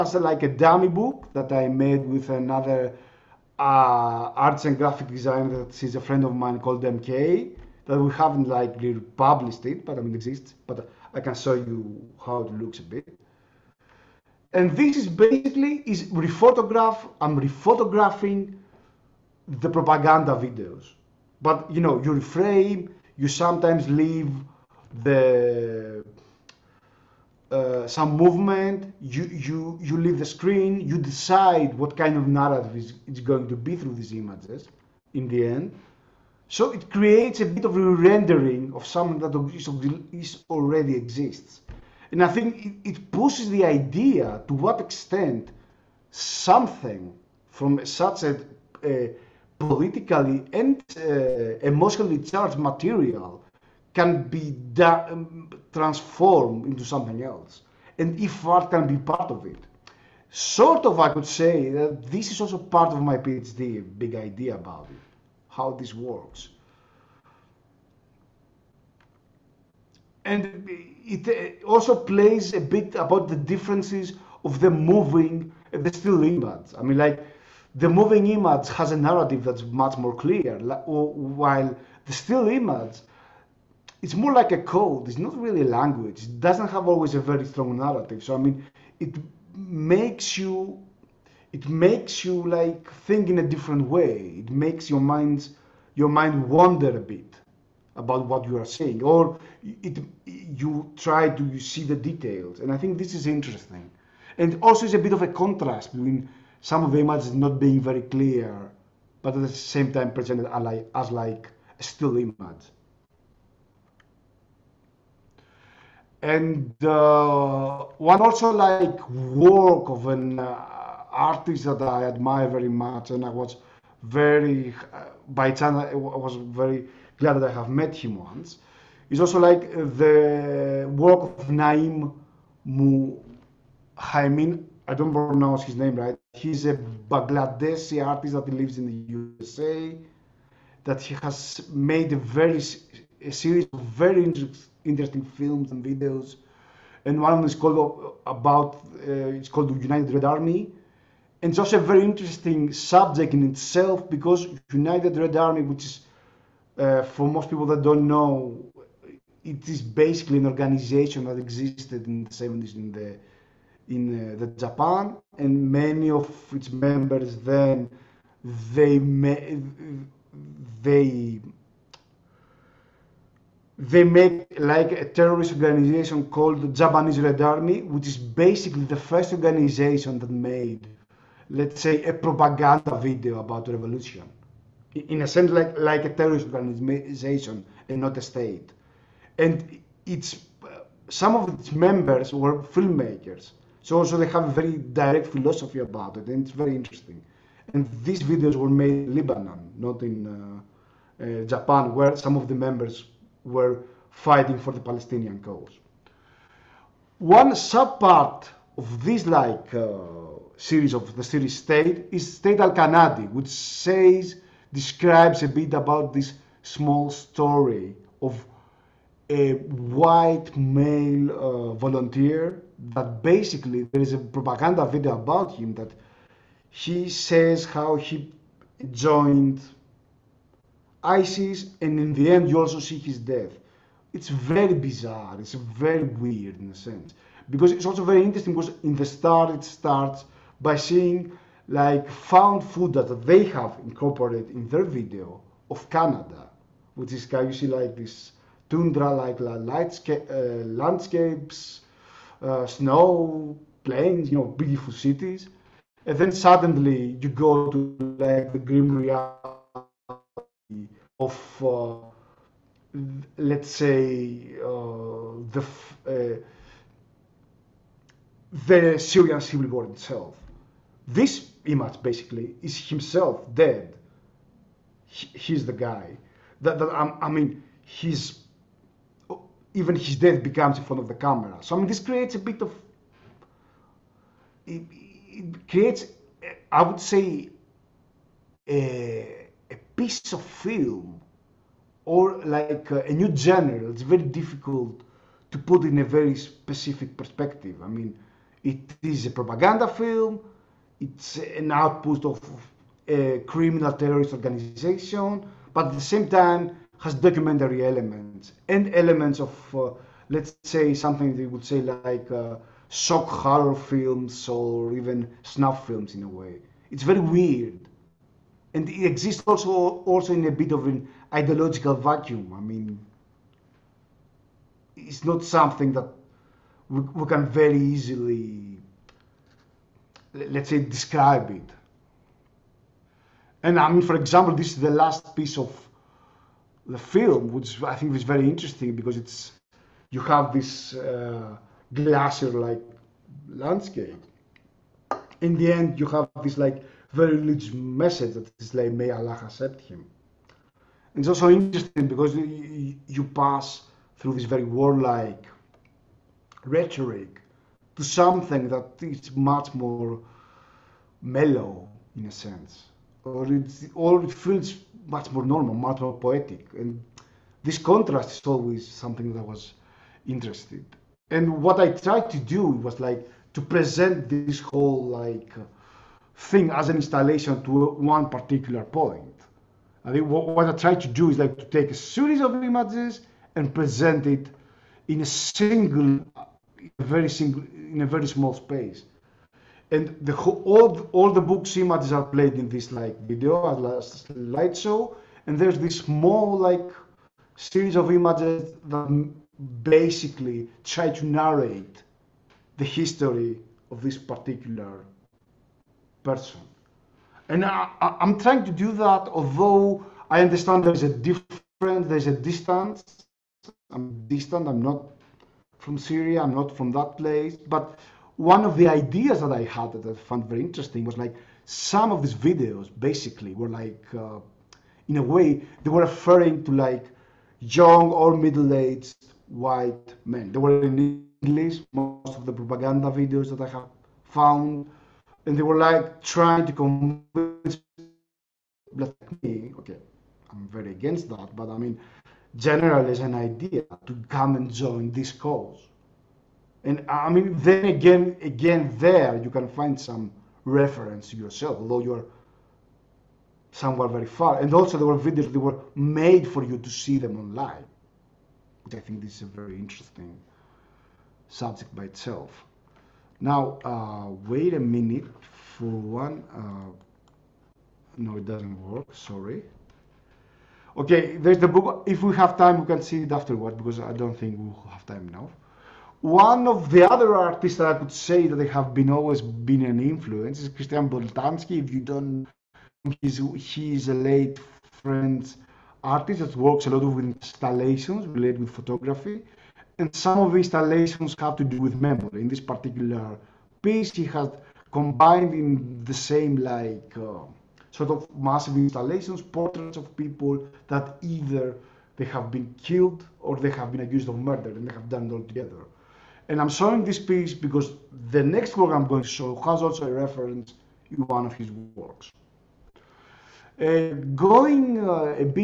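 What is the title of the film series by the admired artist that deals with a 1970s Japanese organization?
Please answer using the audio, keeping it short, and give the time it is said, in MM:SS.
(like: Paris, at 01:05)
The United Red Army, at 02:29.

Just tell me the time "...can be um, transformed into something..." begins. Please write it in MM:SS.
00:53.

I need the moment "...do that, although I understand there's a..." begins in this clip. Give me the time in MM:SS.
06:48.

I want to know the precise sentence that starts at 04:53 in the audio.
It's very difficult to put in a very specific perspective.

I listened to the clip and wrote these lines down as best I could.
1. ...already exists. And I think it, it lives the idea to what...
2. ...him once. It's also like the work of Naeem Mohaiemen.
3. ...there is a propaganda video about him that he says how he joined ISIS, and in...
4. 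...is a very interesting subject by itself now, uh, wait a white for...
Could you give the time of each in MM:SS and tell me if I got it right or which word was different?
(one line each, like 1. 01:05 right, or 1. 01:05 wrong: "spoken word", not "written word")
1. 00:40 wrong: "pushes", not "lives"
2. 02:08 right
3. 03:43 right
4. 07:39 wrong: "minute", not "white".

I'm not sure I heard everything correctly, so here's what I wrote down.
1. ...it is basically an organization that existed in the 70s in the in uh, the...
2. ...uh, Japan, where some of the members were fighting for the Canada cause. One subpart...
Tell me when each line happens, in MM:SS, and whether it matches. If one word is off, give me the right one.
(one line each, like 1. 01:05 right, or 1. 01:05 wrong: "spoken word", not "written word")
1. 02:39 right
2. 03:21 wrong: "Palestinian", not "Canada".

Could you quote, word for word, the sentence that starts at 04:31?
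This image basically is himself dead.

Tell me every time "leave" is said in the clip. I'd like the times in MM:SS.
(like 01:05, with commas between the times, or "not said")
00:23, 00:29.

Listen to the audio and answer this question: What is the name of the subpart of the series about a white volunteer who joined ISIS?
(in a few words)
State al-Kanadi.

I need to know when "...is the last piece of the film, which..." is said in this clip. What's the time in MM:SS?
05:34.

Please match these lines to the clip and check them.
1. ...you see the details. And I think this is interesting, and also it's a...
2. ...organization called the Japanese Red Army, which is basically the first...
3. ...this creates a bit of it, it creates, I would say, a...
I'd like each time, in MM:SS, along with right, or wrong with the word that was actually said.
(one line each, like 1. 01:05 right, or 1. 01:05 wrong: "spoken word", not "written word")
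1. 01:41 right
2. 02:55 right
3. 04:41 right.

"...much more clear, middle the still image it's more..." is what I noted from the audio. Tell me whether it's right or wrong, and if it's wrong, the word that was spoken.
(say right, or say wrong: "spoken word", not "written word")
wrong: "while", not "middle".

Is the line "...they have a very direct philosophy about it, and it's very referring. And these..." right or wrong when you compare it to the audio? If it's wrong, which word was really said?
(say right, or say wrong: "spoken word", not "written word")
wrong: "interesting", not "referring".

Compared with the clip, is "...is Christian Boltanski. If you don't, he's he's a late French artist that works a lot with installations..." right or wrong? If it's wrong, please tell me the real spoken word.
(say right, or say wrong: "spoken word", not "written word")
right.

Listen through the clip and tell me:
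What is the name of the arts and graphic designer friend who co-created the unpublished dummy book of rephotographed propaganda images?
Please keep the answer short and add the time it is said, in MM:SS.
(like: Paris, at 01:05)
MK, at 00:06.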